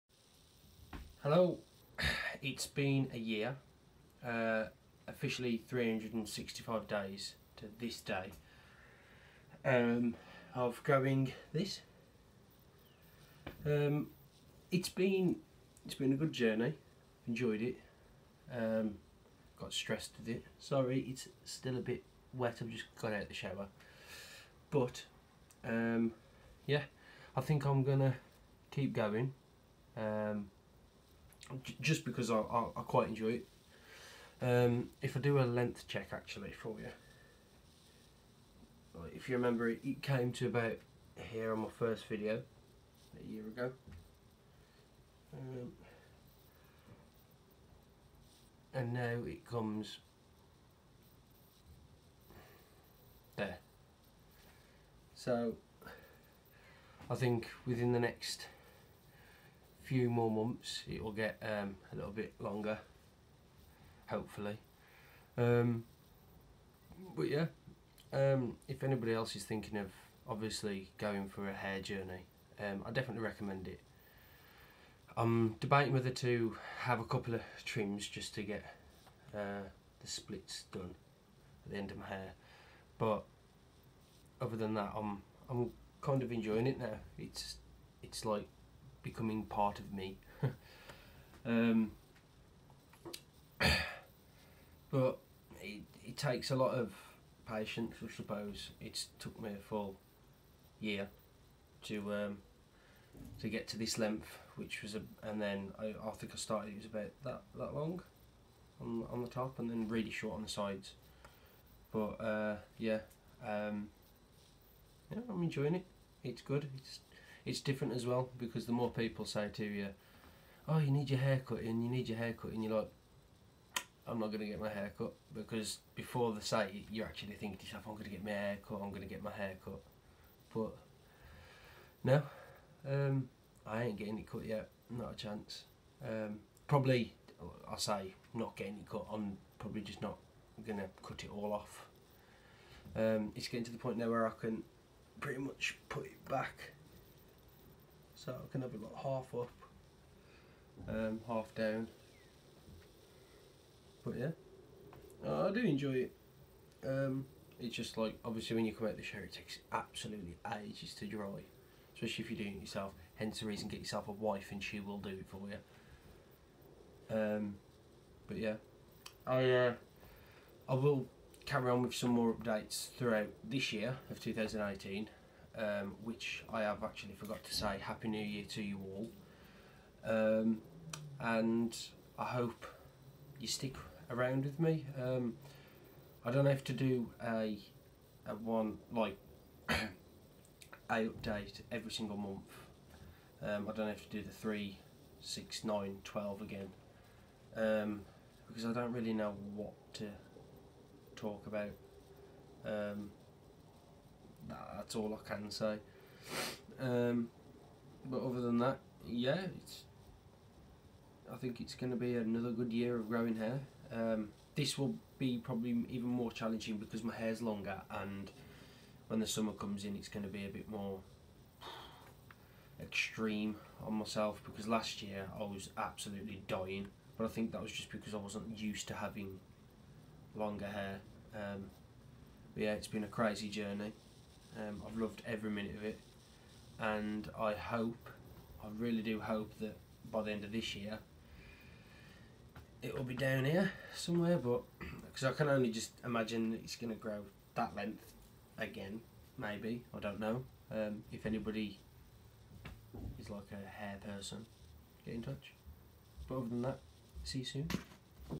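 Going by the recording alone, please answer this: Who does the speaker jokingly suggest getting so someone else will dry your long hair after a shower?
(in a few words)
A wife.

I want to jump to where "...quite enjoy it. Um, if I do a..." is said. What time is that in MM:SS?
00:32.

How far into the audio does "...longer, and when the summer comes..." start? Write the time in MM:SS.
03:37.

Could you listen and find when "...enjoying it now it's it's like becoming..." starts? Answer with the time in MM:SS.
01:26.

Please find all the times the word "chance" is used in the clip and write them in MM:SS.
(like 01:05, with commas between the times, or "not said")
02:15.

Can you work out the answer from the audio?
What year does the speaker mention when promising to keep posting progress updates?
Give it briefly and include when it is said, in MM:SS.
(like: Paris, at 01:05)
2018, at 02:54.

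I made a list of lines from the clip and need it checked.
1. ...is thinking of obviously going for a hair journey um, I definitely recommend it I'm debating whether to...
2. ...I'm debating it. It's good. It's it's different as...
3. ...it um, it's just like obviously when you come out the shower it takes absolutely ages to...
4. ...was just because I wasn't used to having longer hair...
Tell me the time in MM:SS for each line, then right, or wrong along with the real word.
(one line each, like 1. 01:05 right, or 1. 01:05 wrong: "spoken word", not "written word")
1. 01:09 right
2. 01:55 wrong: "enjoying", not "debating"
3. 02:36 right
4. 03:47 right.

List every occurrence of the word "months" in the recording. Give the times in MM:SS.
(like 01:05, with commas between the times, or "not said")
01:00, 03:12.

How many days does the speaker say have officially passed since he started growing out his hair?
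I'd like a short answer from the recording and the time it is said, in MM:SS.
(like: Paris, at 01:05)
365, at 00:05.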